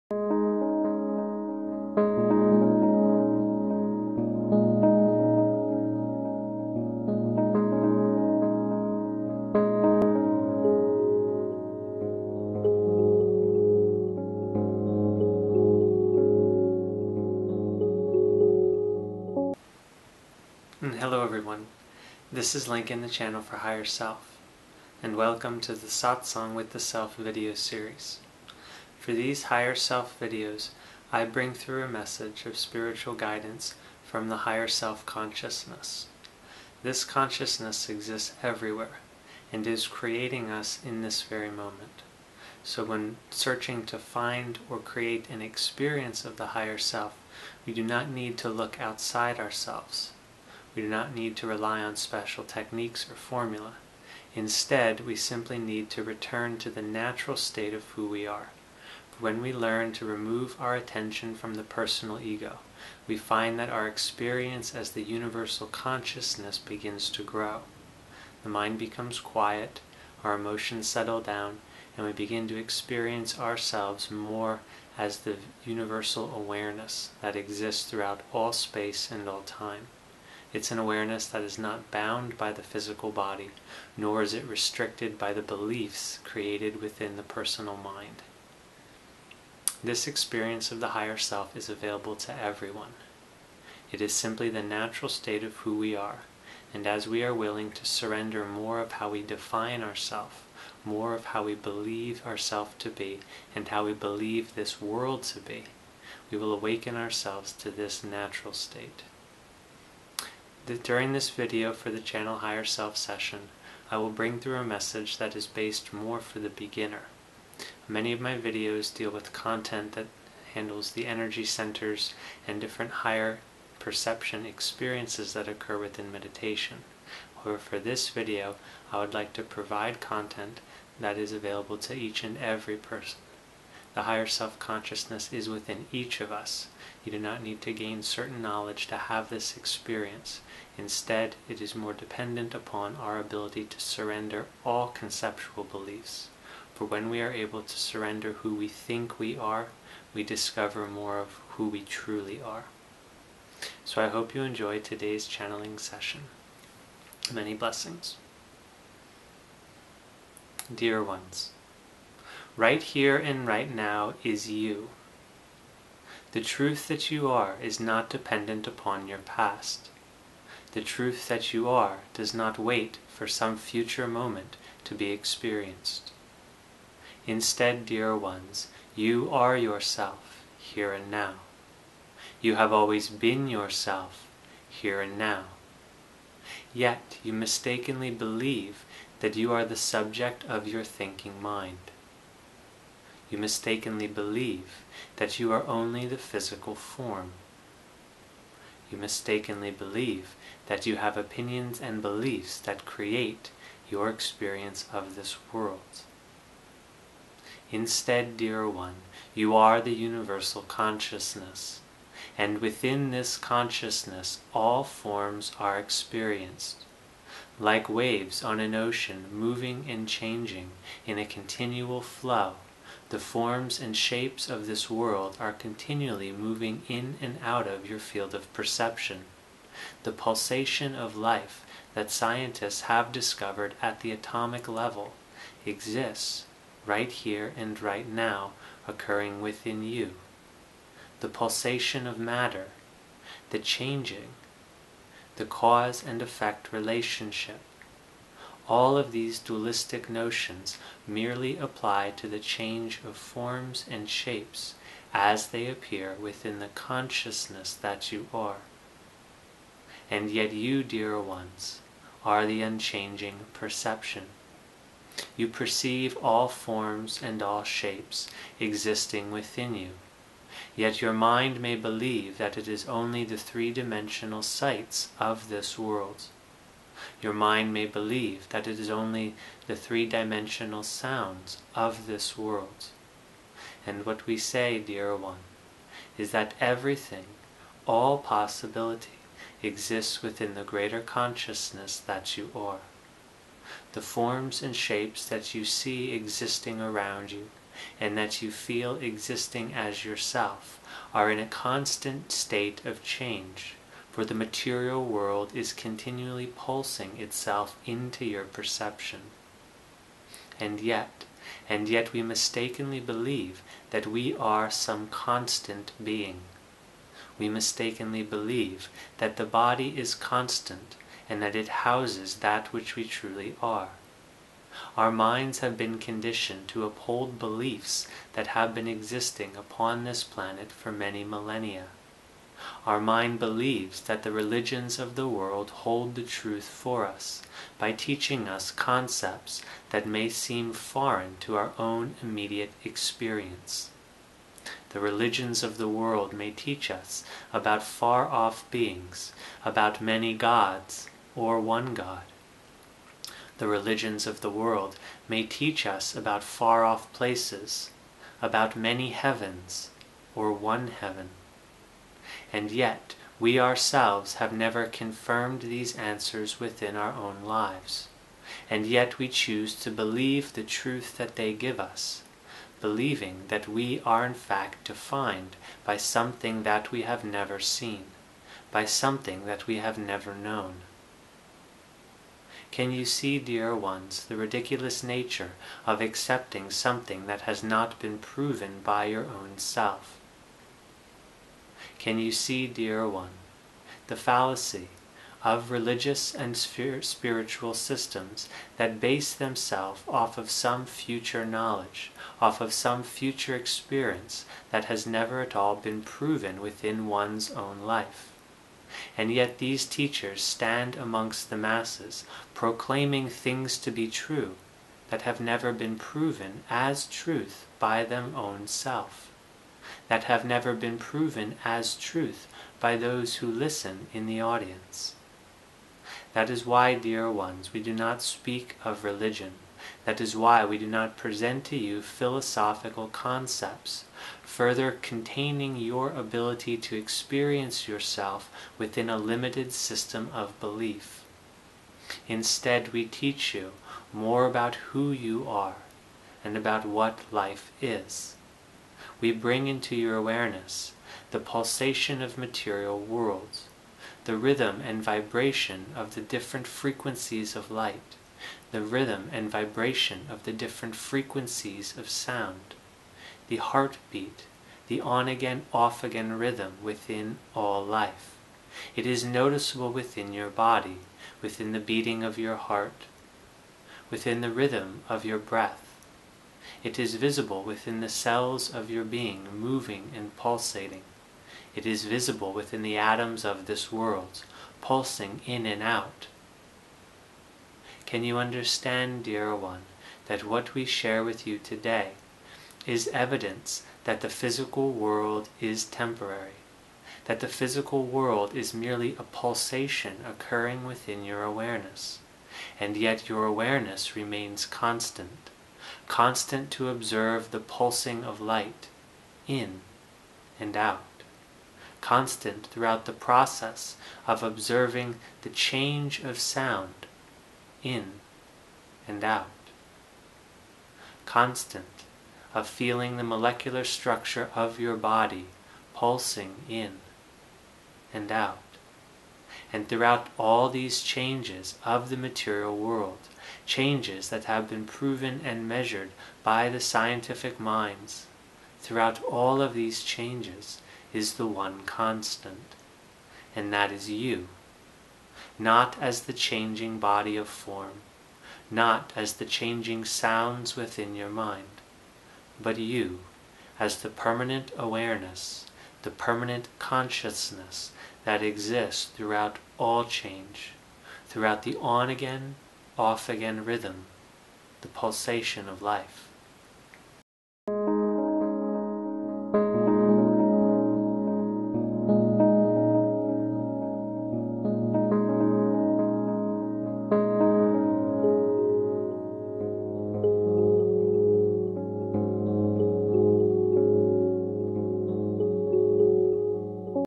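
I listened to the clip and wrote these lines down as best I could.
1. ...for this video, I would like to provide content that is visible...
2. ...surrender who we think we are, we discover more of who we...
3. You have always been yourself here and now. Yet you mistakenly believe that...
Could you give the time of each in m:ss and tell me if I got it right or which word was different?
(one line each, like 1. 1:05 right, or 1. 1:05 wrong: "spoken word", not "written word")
1. 2:07 wrong: "available", not "visible"
2. 2:27 right
3. 3:02 right.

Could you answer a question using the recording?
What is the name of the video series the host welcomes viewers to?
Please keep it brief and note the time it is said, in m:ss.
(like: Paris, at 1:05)
Satsang with the Self, at 0:25.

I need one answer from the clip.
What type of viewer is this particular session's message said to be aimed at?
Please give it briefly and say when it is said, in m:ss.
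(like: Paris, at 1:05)
The beginner, at 1:56.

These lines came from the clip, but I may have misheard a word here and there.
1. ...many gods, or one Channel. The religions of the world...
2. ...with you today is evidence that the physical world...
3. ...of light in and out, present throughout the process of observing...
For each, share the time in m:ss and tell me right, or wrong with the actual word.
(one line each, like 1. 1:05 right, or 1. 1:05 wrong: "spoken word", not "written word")
1. 5:49 wrong: "God", not "Channel"
2. 8:11 right
3. 8:28 wrong: "constant", not "present".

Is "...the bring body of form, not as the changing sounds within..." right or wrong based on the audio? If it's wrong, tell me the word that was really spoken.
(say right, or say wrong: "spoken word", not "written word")
wrong: "changing", not "bring".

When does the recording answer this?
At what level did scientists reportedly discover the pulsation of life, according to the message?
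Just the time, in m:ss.
3:54.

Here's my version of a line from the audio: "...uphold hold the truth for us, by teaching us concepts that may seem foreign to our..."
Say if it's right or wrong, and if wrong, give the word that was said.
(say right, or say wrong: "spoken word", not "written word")
wrong: "world", not "uphold".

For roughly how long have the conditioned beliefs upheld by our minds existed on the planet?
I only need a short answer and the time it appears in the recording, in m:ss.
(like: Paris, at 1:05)
Many millennia, at 5:30.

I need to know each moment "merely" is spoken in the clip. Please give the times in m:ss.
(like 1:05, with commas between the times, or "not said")
4:11, 8:18.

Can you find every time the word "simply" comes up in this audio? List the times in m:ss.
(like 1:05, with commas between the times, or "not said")
0:55, 1:34.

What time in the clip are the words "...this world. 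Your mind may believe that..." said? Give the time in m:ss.
4:35.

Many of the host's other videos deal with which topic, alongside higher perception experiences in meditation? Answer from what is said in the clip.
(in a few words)
Energy centers.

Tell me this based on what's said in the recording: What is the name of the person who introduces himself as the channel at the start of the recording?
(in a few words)
Lincoln.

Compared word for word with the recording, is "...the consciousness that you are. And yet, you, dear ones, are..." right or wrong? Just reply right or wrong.
right.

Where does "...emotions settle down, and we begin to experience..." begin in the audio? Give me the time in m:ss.
1:10.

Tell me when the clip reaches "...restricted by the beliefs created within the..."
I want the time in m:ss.
1:24.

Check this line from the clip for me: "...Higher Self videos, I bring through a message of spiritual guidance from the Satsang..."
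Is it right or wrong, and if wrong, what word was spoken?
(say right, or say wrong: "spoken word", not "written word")
wrong: "Higher", not "Satsang".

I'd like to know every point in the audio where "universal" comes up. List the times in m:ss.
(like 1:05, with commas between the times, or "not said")
1:05, 1:15, 3:29.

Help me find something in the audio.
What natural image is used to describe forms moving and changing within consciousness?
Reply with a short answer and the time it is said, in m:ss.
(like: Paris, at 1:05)
Waves on an ocean, at 3:37.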